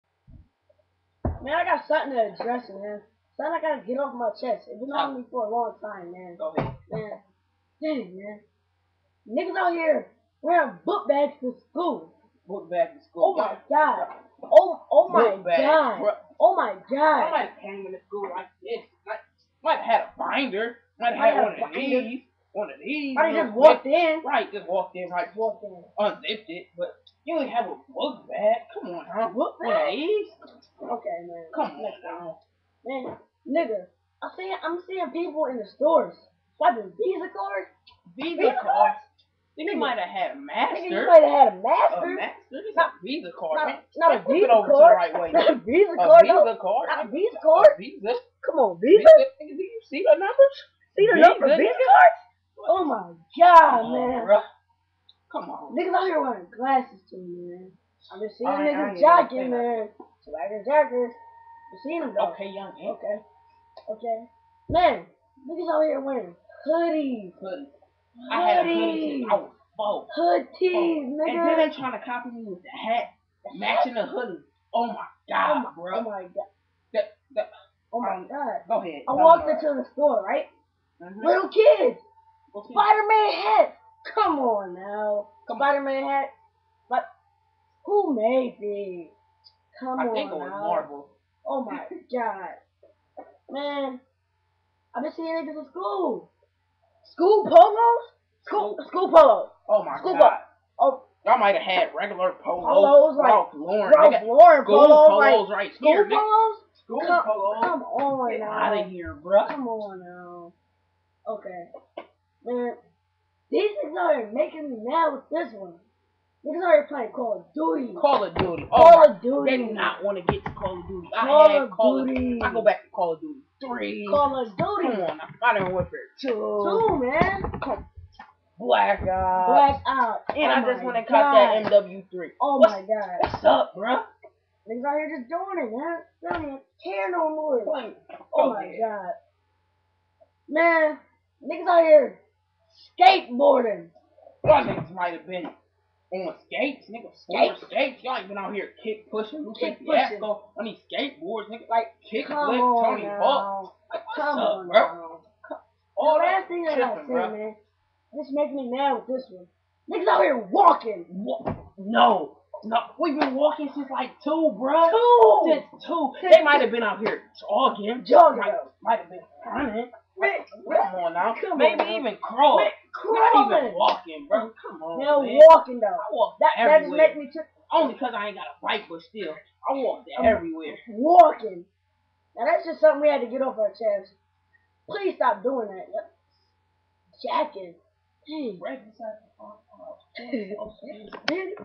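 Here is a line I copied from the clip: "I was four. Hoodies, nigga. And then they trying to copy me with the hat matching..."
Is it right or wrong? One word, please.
right.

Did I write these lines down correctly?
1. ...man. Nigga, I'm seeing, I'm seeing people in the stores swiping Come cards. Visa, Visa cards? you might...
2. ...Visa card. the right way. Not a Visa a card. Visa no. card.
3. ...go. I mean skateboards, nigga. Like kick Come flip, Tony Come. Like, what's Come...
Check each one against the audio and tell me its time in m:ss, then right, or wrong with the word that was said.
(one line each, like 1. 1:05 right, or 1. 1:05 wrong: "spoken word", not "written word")
1. 0:32 wrong: "Visa", not "Come"
2. 0:44 right
3. 2:29 wrong: "Hawk", not "Come".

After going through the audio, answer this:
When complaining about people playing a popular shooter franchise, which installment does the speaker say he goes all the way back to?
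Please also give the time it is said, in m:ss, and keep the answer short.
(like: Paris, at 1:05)
Call of Duty 3, at 2:02.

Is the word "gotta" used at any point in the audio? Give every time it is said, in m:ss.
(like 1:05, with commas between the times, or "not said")
0:03.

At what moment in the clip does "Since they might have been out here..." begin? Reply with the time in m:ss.
2:46.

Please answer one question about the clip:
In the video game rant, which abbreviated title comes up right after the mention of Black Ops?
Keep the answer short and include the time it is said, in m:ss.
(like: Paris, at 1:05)
MW3, at 2:11.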